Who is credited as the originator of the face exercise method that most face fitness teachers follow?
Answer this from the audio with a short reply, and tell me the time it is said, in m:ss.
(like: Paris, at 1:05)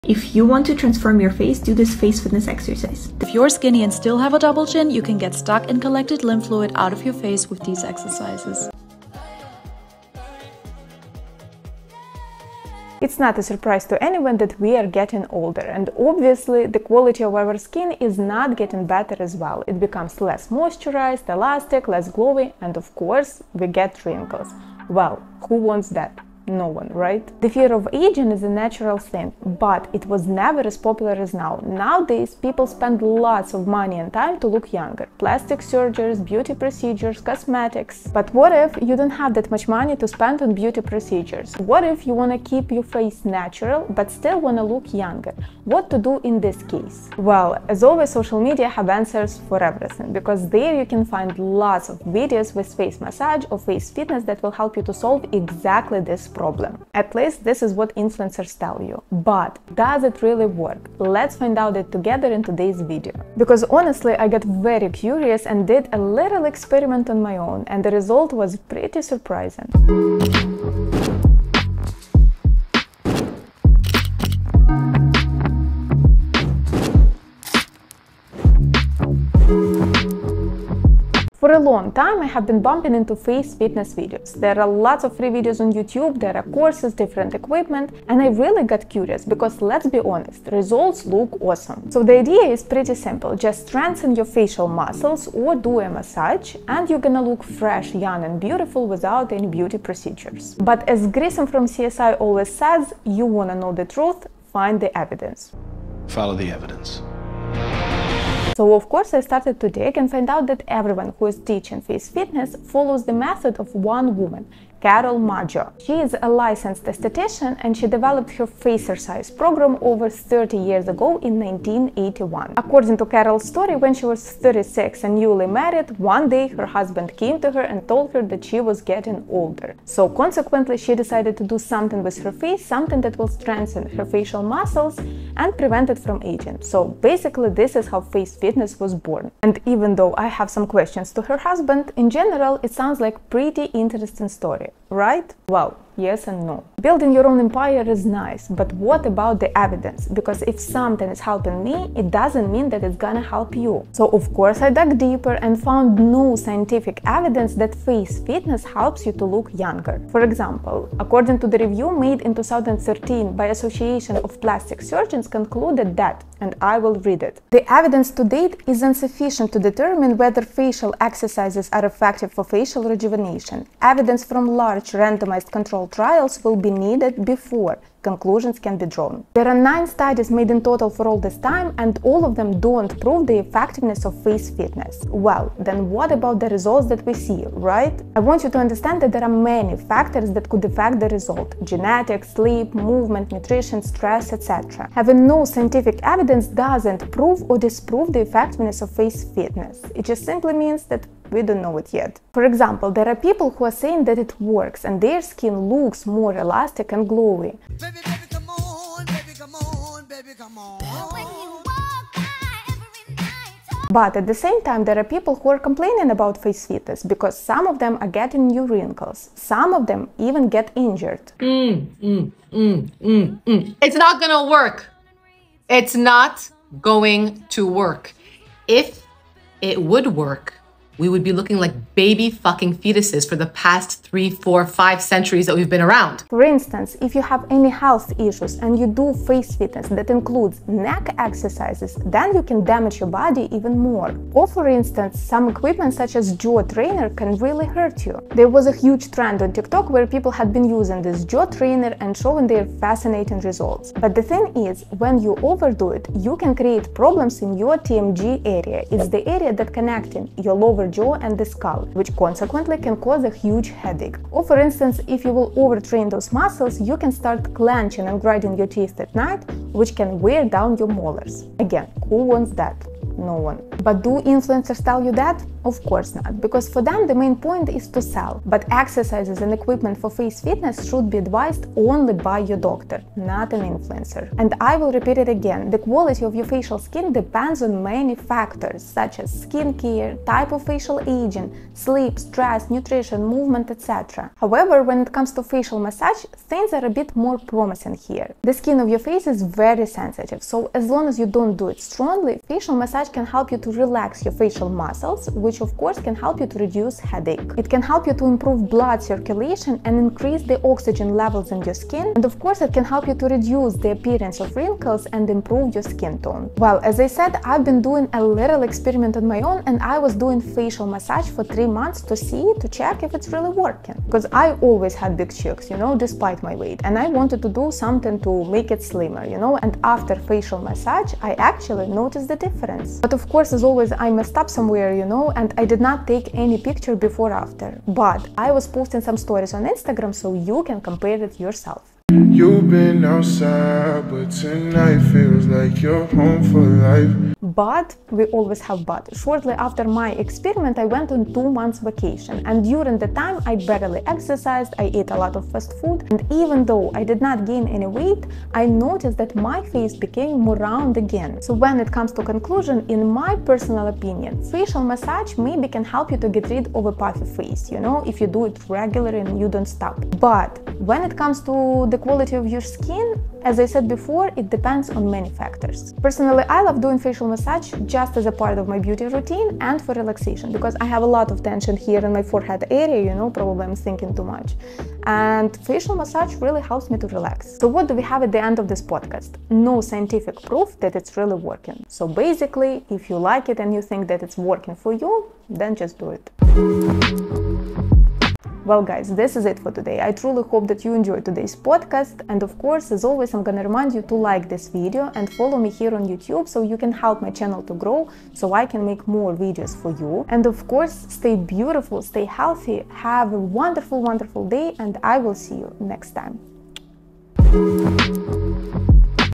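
Carol Maggio, at 1:54.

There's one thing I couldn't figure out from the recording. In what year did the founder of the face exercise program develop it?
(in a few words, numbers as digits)
1981.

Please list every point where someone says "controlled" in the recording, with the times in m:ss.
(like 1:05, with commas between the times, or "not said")
2:55.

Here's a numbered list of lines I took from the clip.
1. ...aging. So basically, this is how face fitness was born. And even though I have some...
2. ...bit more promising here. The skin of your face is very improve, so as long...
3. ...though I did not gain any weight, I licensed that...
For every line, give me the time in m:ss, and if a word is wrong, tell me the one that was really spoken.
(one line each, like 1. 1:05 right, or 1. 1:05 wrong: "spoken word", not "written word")
1. 2:16 right
2. 4:56 wrong: "sensitive", not "improve"
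3. 5:56 wrong: "noticed", not "licensed".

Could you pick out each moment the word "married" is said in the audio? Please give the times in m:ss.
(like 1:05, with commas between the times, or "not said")
2:05.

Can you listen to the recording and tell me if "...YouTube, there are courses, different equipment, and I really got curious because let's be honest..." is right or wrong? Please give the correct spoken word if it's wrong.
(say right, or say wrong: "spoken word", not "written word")
right.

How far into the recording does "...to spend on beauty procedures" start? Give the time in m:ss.
0:39.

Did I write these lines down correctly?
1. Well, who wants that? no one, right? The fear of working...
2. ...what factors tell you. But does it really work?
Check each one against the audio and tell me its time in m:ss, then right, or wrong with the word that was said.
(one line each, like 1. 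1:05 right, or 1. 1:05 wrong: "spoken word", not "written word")
1. 0:24 wrong: "aging", not "working"
2. 0:57 wrong: "influencers", not "factors".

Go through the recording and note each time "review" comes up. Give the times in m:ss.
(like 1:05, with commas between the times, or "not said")
2:41.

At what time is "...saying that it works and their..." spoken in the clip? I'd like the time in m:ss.
3:23.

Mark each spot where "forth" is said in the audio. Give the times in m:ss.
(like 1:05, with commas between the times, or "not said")
not said.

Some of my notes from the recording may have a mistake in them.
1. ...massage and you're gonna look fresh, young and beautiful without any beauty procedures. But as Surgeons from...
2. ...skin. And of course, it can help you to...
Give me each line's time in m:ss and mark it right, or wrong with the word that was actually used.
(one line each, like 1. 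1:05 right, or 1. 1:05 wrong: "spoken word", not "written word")
1. 1:35 wrong: "Grissom", not "Surgeons"
2. 5:11 right.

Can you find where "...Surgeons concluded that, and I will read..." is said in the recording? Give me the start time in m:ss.
2:44.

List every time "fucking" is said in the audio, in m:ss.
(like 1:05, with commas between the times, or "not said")
3:52.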